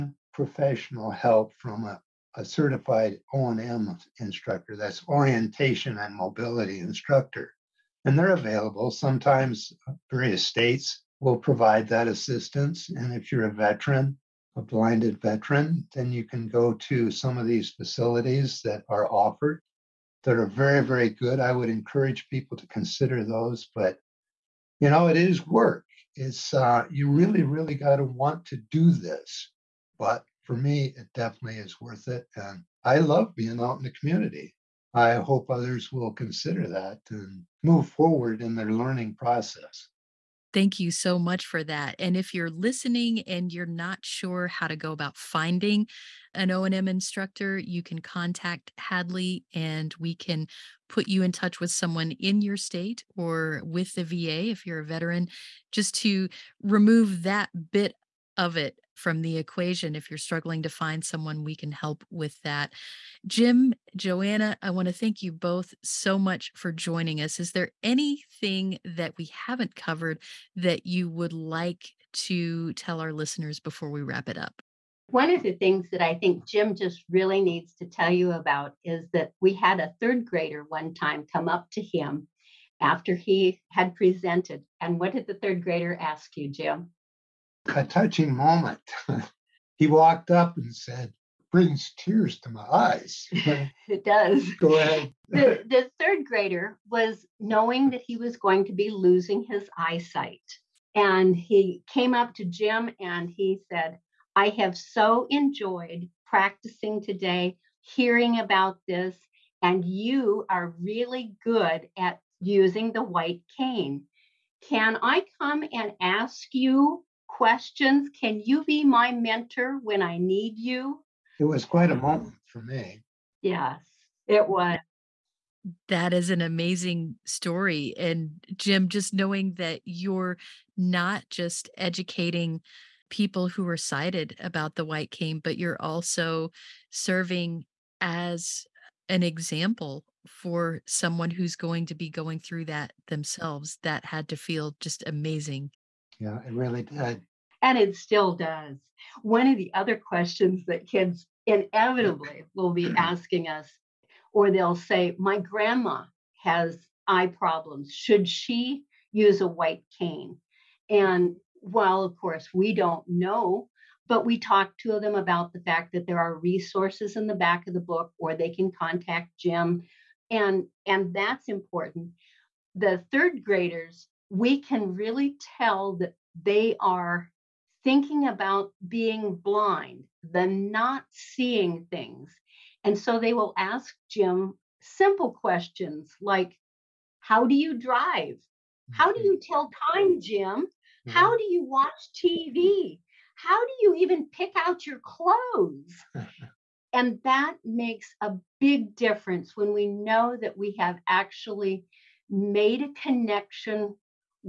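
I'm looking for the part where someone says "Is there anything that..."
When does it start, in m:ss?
1:07.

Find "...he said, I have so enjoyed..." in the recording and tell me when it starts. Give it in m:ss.
1:43.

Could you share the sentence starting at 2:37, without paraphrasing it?
Should she use a white cane?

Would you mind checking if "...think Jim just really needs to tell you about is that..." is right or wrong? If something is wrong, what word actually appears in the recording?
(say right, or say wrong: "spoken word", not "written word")
right.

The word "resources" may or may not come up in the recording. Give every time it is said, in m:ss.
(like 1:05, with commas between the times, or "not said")
2:46.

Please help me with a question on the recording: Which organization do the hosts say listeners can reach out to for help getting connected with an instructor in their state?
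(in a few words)
Hadley.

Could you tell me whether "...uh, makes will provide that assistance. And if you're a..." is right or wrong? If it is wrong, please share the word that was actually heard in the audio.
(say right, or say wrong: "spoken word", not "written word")
wrong: "states", not "makes".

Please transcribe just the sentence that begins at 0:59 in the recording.
If you're struggling to find someone, we can help with that.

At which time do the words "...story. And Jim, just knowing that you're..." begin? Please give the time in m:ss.
2:07.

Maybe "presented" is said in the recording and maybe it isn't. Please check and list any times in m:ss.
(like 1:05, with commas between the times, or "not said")
1:23.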